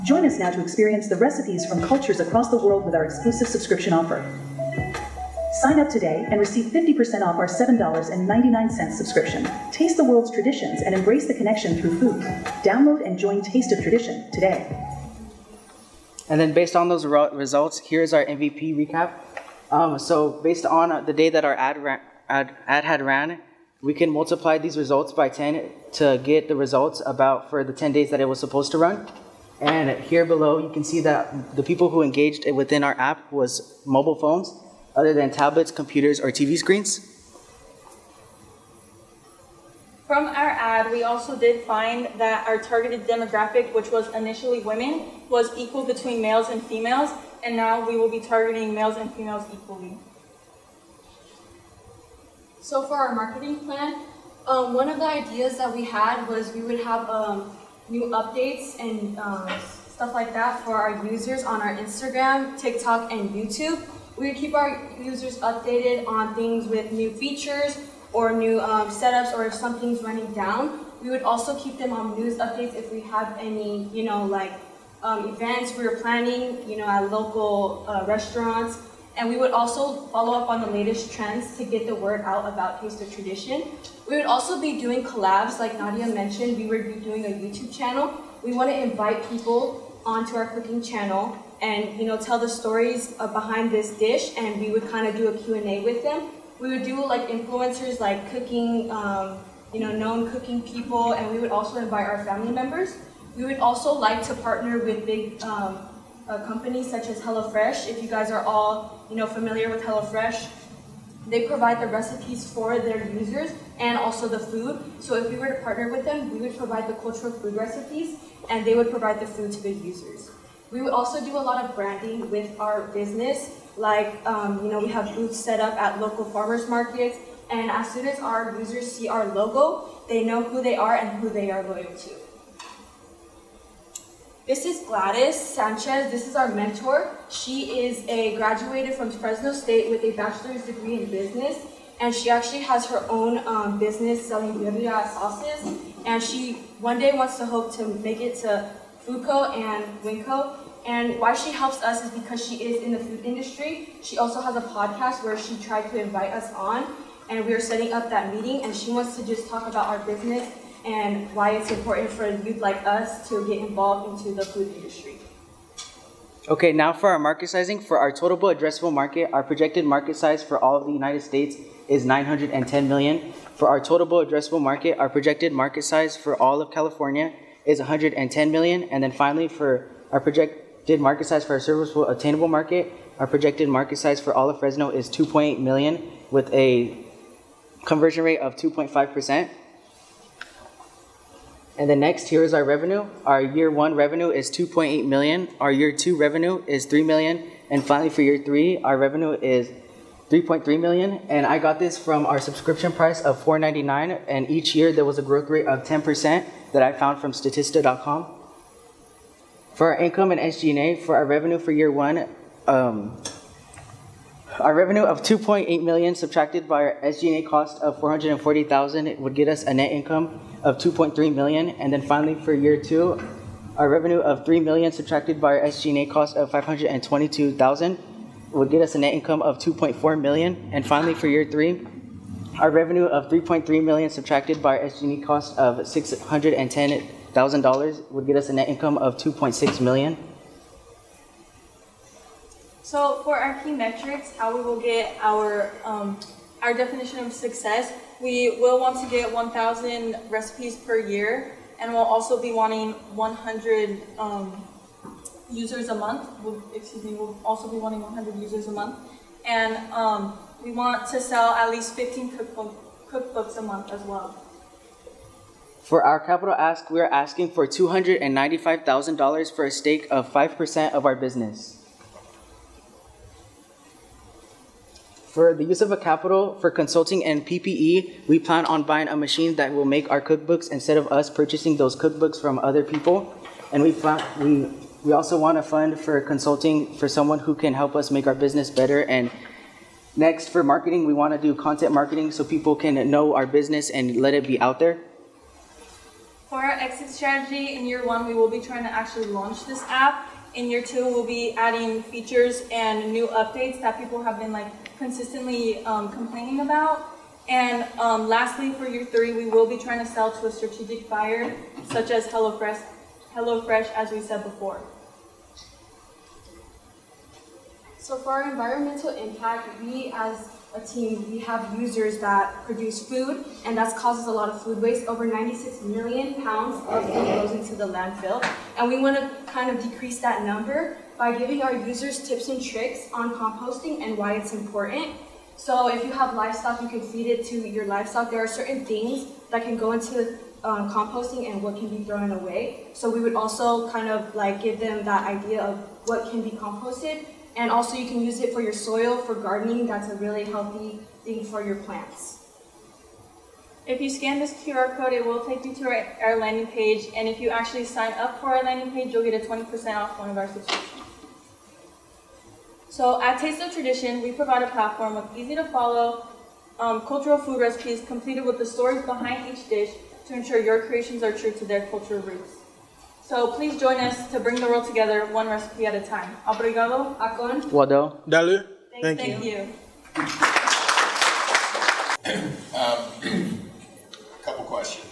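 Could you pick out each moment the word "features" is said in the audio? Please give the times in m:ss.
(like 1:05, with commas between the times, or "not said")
1:07, 5:02.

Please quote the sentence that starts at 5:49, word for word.
That's a really healthy thing for your plants.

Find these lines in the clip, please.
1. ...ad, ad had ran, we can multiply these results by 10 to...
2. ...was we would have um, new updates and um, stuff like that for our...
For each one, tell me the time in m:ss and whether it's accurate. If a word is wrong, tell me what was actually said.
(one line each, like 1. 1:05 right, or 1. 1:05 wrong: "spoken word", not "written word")
1. 0:22 right
2. 0:56 right.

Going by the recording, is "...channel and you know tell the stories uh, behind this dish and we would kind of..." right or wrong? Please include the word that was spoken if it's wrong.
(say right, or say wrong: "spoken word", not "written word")
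right.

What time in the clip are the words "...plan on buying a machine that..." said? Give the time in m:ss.
4:38.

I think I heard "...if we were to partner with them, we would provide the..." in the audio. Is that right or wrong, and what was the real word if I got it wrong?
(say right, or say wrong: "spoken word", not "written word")
right.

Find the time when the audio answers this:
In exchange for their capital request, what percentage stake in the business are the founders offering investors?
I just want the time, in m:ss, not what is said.
4:30.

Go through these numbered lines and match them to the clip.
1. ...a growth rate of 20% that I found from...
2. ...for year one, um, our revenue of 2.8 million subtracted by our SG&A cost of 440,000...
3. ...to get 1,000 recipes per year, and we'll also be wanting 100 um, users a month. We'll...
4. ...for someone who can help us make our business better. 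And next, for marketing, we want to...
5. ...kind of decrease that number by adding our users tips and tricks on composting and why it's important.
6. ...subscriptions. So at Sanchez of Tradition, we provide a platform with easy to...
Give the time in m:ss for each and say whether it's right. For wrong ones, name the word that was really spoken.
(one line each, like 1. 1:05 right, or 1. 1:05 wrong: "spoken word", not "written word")
1. 3:25 wrong: "10", not "20"
2. 3:31 right
3. 4:09 right
4. 4:46 right
5. 5:29 wrong: "giving", not "adding"
6. 6:00 wrong: "Taste", not "Sanchez".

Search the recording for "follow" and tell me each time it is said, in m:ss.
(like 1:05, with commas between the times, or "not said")
1:20, 6:05.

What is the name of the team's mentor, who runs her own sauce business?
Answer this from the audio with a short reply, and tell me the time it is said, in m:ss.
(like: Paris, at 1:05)
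Gladys Sanchez, at 2:14.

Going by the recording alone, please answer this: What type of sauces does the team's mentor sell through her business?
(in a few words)
birria sauces.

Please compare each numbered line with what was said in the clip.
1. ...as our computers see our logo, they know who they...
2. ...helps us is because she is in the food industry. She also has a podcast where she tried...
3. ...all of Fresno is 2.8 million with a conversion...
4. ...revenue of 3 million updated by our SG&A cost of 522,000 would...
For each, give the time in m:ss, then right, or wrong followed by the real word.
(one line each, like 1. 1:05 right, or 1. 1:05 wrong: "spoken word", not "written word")
1. 2:08 wrong: "users", not "computers"
2. 2:31 right
3. 3:04 right
4. 3:43 wrong: "subtracted", not "updated".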